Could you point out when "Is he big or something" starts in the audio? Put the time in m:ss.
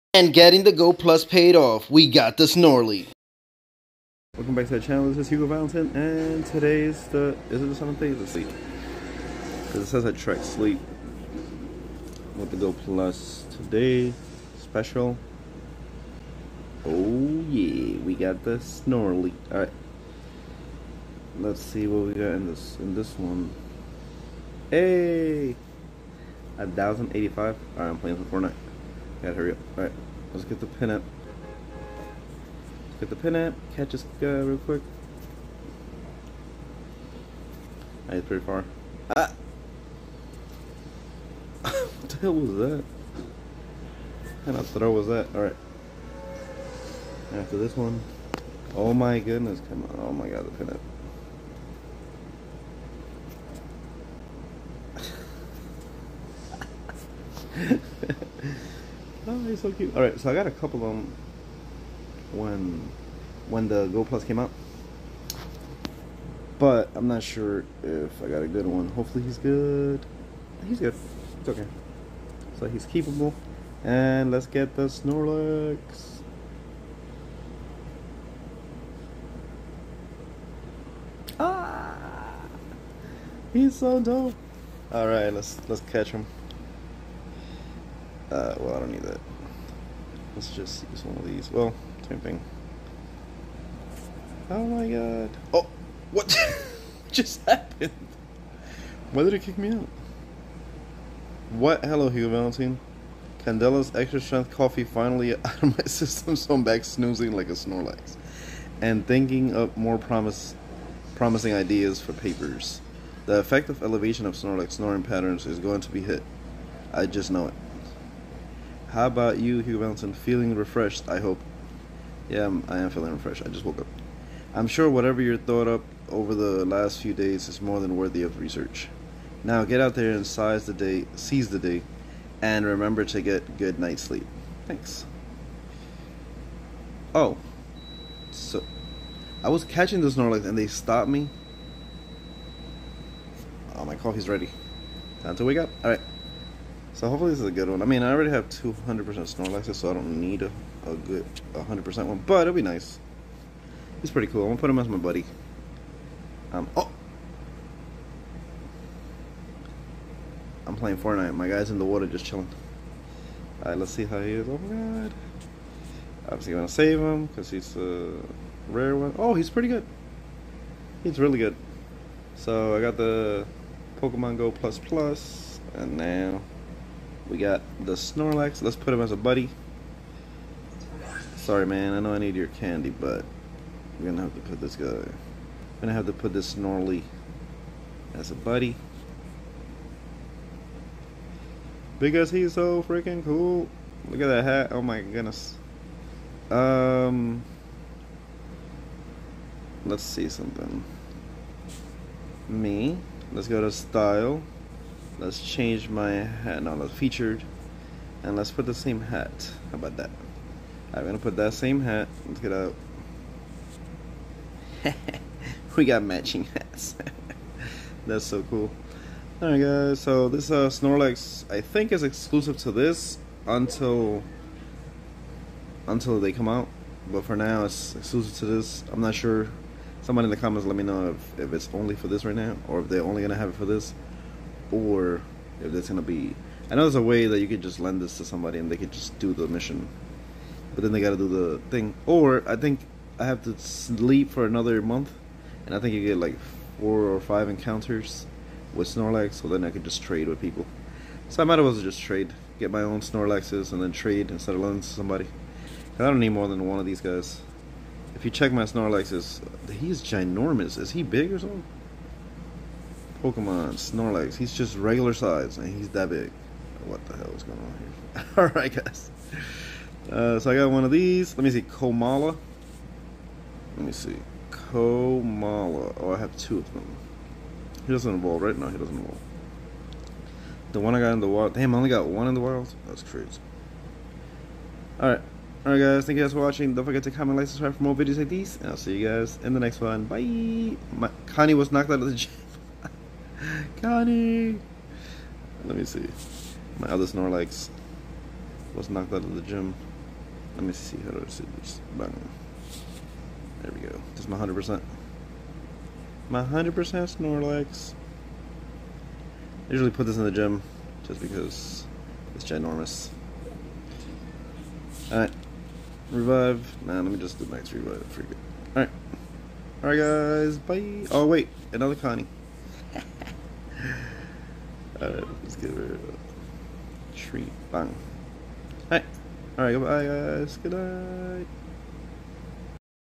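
4:20.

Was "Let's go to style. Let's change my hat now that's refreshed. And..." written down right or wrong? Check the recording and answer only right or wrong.
wrong.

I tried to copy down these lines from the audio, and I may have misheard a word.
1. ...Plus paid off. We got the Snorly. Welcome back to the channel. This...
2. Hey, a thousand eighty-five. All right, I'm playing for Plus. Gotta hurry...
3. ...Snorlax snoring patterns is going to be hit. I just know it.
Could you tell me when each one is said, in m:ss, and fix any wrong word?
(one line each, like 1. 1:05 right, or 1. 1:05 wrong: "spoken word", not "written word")
1. 0:00 right
2. 0:24 wrong: "Fortnite", not "Plus"
3. 1:54 right.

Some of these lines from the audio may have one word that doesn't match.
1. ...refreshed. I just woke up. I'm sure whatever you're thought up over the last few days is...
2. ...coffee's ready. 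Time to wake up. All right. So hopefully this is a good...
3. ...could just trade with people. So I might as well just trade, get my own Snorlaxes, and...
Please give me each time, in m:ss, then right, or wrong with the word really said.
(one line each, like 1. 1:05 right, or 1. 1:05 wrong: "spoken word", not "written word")
1. 2:03 right
2. 2:23 right
3. 4:09 right.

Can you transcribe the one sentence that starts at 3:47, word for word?
But for now it's exclusive to this.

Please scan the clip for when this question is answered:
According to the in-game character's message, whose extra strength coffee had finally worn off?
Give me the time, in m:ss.
1:43.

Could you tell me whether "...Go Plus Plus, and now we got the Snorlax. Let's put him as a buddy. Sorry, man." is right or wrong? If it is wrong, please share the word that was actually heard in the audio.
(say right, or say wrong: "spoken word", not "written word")
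right.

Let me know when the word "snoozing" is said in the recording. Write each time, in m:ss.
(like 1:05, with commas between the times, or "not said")
1:46.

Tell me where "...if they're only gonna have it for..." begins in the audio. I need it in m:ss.
3:52.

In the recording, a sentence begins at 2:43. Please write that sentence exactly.
Alright, let's see how he is.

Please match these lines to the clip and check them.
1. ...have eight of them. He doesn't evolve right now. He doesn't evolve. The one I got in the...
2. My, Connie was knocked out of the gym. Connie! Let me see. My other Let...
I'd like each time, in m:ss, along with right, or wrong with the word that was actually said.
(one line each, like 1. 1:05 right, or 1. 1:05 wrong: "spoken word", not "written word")
1. 4:36 wrong: "two", not "eight"
2. 4:50 wrong: "Snorlax", not "Let".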